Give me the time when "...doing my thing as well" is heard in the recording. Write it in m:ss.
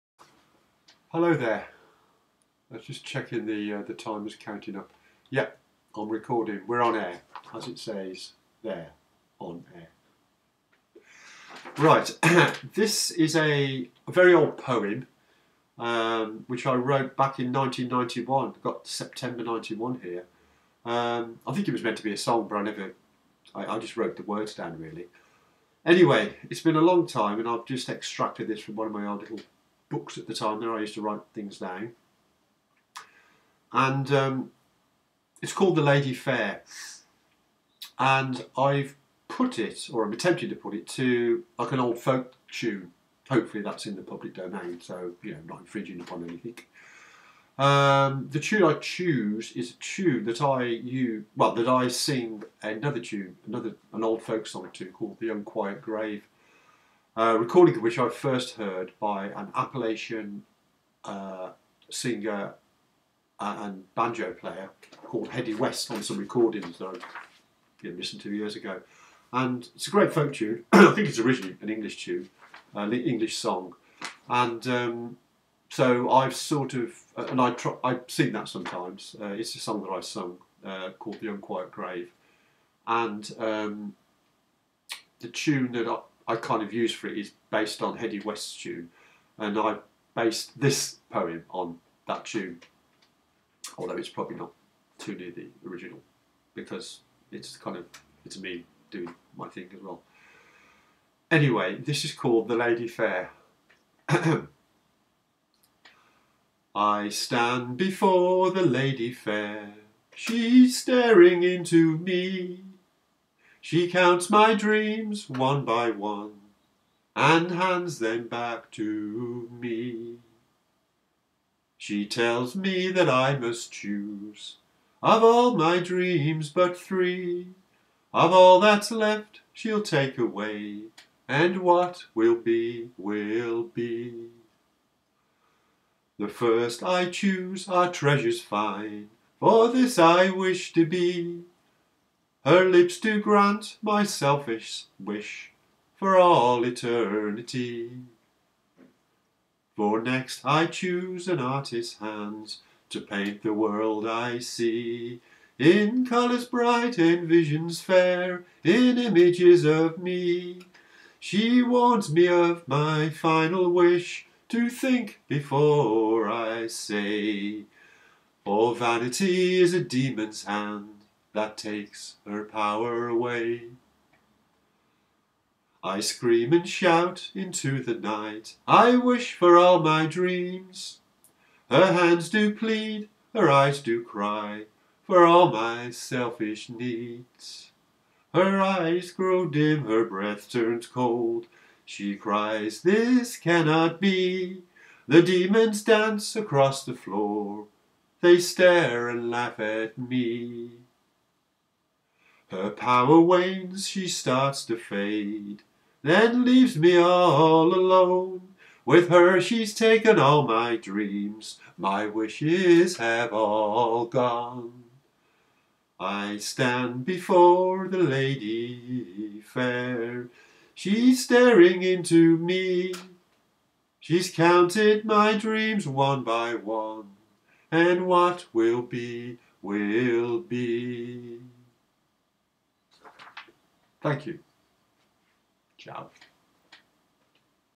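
1:38.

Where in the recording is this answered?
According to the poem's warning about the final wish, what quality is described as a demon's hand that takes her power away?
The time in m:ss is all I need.
2:48.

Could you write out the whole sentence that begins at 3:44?
She's counted my dreams one by one, and what will be, will be.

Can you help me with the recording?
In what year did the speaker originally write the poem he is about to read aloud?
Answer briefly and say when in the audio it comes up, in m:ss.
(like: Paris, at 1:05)
1991, at 0:17.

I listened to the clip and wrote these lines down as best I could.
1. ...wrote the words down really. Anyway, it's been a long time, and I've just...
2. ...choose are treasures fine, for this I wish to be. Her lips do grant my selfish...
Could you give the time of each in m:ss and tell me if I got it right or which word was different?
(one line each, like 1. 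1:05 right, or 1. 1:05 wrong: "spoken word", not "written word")
1. 0:23 right
2. 2:17 right.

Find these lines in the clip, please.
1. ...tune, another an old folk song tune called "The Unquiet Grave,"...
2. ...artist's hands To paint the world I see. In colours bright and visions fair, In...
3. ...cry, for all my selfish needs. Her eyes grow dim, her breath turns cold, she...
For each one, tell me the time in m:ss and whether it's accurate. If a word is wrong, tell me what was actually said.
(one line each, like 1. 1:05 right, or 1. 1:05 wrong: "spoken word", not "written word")
1. 0:53 right
2. 2:31 right
3. 3:04 right.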